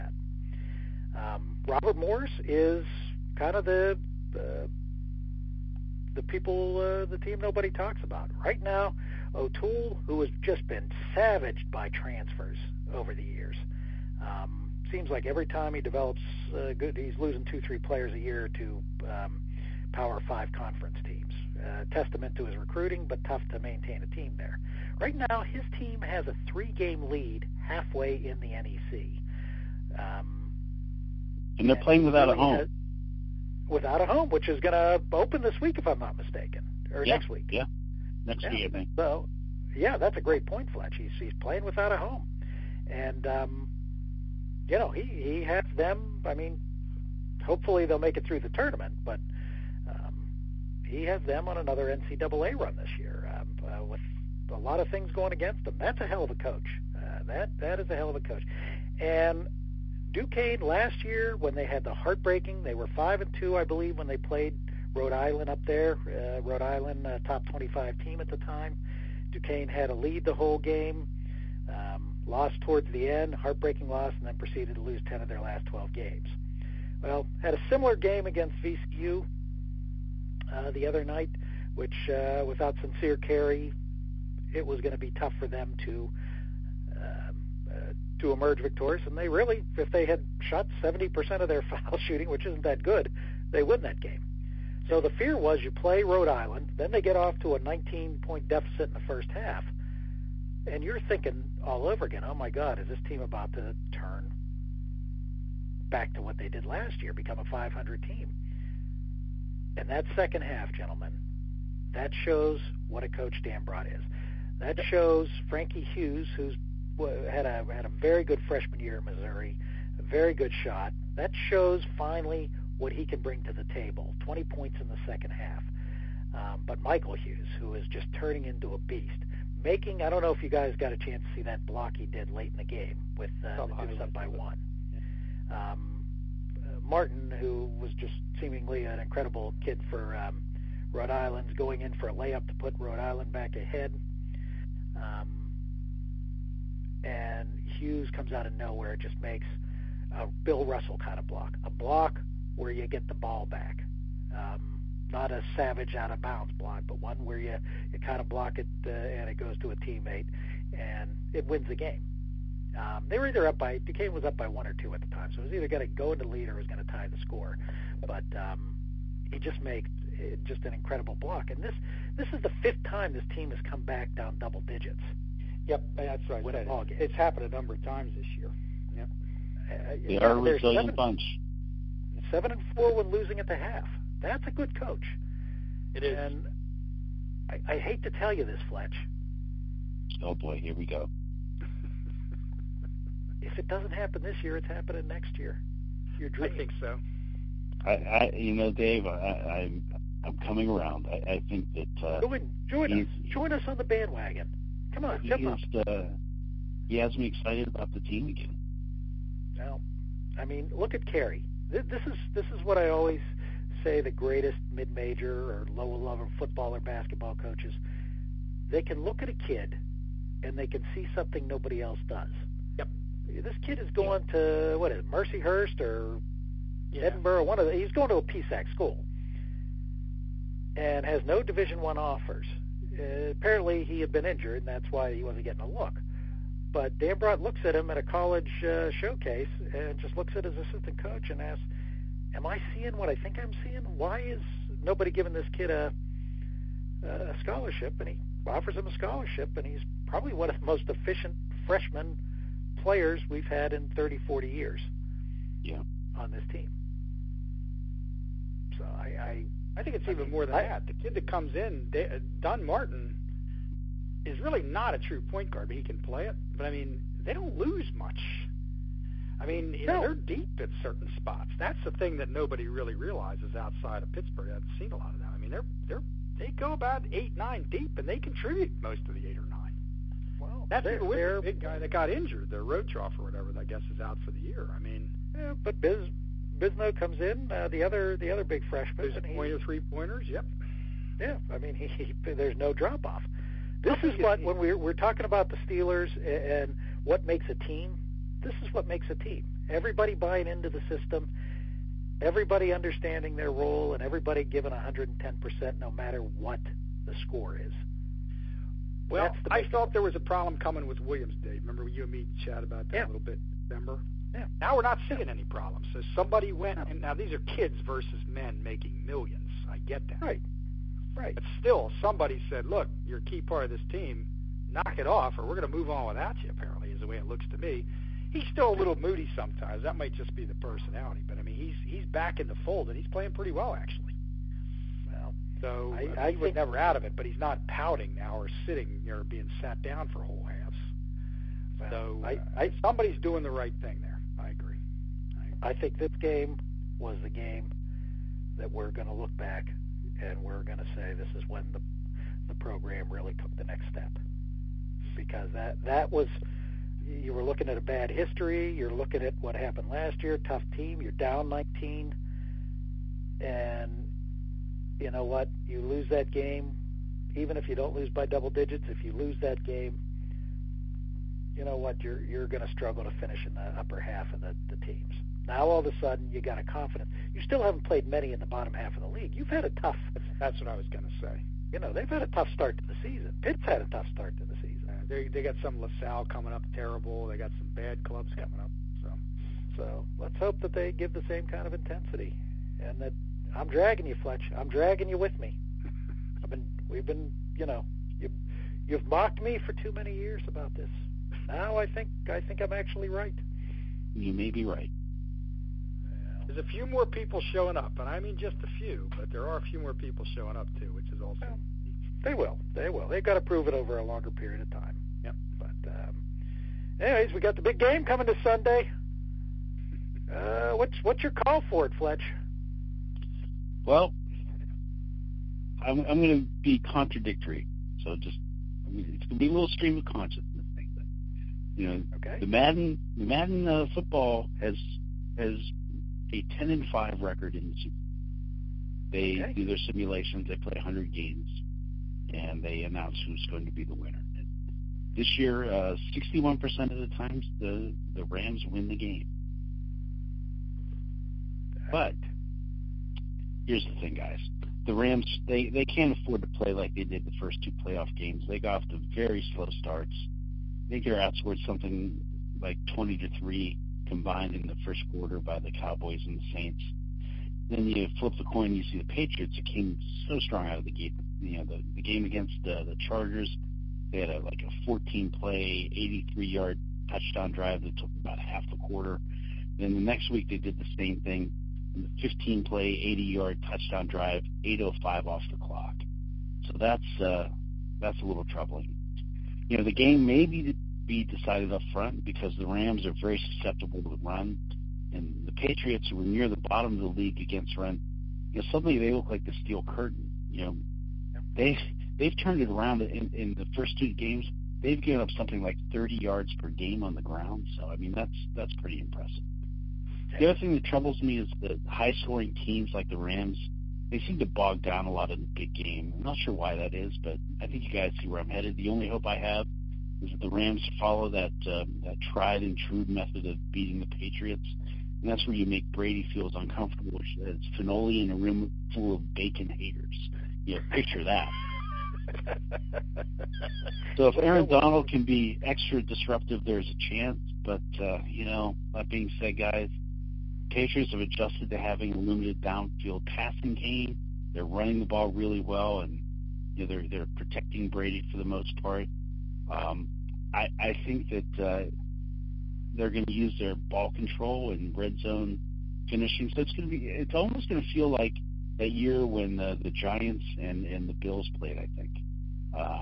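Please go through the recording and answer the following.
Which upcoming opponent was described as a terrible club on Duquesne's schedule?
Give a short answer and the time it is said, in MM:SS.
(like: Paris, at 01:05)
LaSalle, at 06:25.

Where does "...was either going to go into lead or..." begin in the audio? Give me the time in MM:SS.
02:45.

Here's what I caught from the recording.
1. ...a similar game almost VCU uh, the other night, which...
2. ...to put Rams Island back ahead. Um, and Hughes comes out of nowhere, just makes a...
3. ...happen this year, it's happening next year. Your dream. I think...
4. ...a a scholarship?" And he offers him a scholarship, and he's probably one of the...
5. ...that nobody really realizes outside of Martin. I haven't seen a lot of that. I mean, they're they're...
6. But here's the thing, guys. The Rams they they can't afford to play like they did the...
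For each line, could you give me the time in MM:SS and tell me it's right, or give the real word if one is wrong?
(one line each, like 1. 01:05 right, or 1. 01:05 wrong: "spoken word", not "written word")
1. 01:17 wrong: "against", not "almost"
2. 02:22 wrong: "Rhode", not "Rams"
3. 03:13 right
4. 04:05 right
5. 04:32 wrong: "Pittsburgh", not "Martin"
6. 07:31 right.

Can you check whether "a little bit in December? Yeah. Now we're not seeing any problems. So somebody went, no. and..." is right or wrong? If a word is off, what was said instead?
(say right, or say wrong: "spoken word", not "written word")
right.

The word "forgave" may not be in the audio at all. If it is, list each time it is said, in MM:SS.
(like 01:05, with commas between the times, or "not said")
not said.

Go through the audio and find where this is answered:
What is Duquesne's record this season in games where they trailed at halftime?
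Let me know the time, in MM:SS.
03:02.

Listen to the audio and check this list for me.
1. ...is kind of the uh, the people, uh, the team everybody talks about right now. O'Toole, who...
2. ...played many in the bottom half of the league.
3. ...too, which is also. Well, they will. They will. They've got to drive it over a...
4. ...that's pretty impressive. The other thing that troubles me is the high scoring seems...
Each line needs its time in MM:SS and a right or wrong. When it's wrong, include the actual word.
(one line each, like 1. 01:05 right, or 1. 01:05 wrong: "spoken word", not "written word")
1. 00:02 wrong: "nobody", not "everybody"
2. 06:17 right
3. 06:50 wrong: "prove", not "drive"
4. 08:28 wrong: "teams", not "seems".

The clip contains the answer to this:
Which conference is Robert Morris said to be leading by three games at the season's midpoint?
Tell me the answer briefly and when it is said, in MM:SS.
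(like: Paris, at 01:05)
NEC, at 00:28.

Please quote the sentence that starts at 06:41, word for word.
Now I think, I think I'm actually right.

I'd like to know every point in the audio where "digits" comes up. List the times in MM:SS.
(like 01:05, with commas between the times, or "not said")
02:54, 06:08.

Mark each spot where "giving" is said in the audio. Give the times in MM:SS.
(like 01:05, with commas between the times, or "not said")
04:05, 05:04.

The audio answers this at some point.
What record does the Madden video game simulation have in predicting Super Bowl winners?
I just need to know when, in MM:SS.
07:16.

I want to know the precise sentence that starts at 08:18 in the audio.
You know, suddenly they look like the steel curtain.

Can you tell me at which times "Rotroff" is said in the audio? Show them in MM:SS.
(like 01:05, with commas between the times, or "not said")
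04:42.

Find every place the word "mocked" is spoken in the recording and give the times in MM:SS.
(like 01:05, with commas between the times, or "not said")
06:39.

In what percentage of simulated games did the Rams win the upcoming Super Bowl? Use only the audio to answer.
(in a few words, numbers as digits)
61%.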